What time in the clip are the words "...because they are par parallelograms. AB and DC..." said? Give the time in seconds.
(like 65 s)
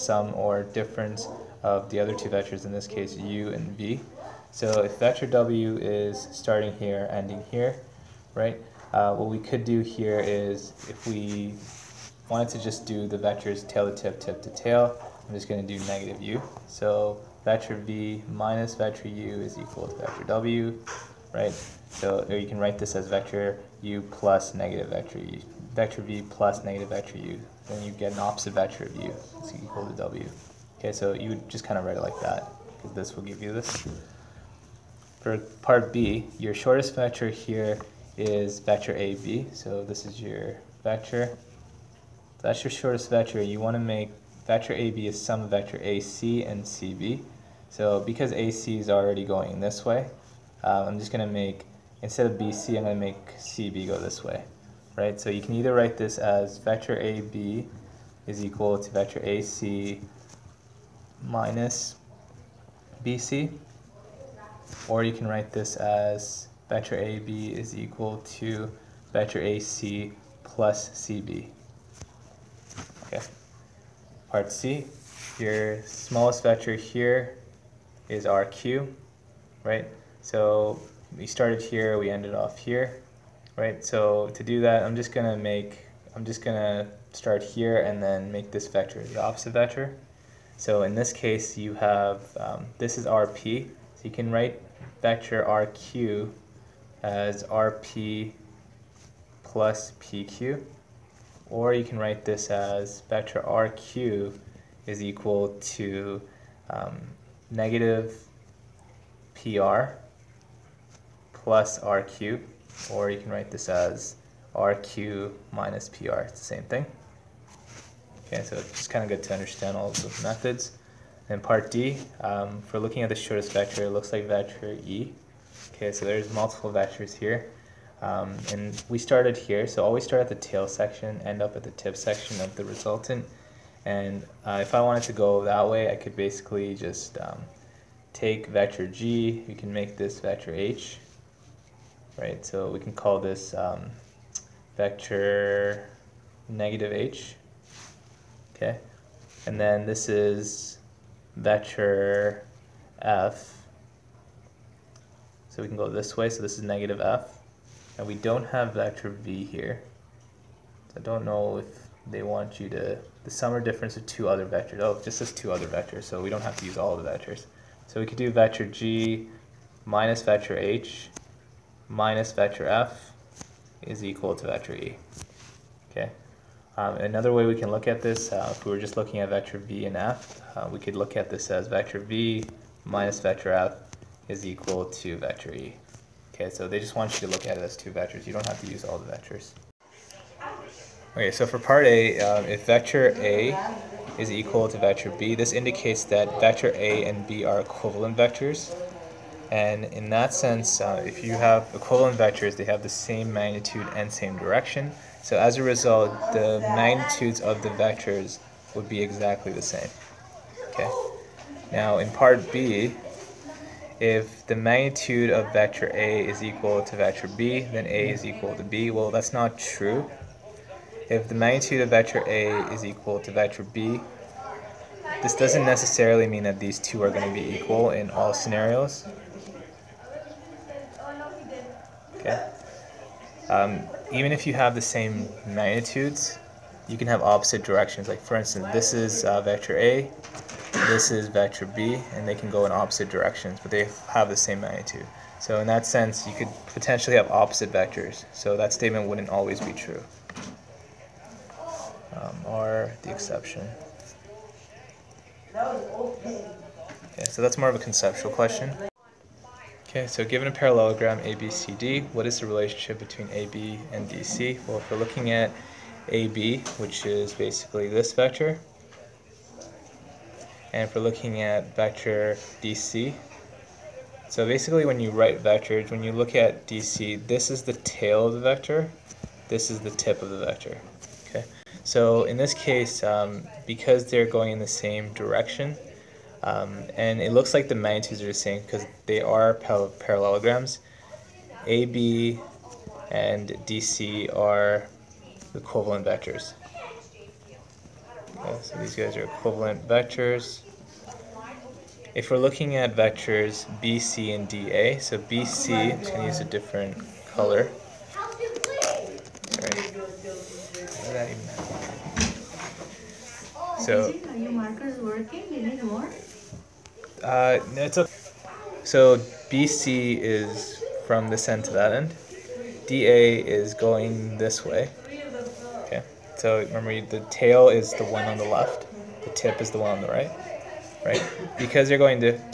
288 s.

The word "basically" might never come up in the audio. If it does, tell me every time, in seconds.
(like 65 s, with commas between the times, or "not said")
136 s, 267 s, 274 s.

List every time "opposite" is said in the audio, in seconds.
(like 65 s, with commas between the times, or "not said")
28 s, 89 s, 237 s, 242 s, 247 s.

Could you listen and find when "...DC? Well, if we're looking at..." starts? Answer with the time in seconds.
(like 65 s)
264 s.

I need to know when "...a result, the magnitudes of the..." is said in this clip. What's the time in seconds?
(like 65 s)
205 s.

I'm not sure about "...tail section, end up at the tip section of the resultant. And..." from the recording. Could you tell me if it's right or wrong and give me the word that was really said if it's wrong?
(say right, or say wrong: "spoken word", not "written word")
right.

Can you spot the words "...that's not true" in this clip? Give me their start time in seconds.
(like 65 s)
219 s.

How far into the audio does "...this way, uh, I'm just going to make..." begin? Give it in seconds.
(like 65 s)
49 s.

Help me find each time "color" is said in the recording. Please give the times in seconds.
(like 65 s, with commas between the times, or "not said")
307 s.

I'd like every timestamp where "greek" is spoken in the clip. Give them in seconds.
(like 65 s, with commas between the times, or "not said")
not said.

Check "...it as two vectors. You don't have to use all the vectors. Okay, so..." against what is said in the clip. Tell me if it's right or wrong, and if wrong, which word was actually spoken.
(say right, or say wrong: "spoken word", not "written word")
right.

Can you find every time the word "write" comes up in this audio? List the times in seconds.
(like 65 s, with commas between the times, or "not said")
22 s, 31 s, 55 s, 65 s, 94 s, 101 s, 113 s, 275 s.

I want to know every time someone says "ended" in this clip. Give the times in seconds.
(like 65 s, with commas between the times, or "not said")
82 s.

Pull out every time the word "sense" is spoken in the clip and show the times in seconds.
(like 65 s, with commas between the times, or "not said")
200 s, 245 s.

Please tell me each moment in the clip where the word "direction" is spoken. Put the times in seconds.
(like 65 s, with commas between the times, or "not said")
204 s, 237 s, 243 s, 285 s.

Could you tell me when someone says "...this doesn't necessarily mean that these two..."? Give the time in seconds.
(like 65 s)
225 s.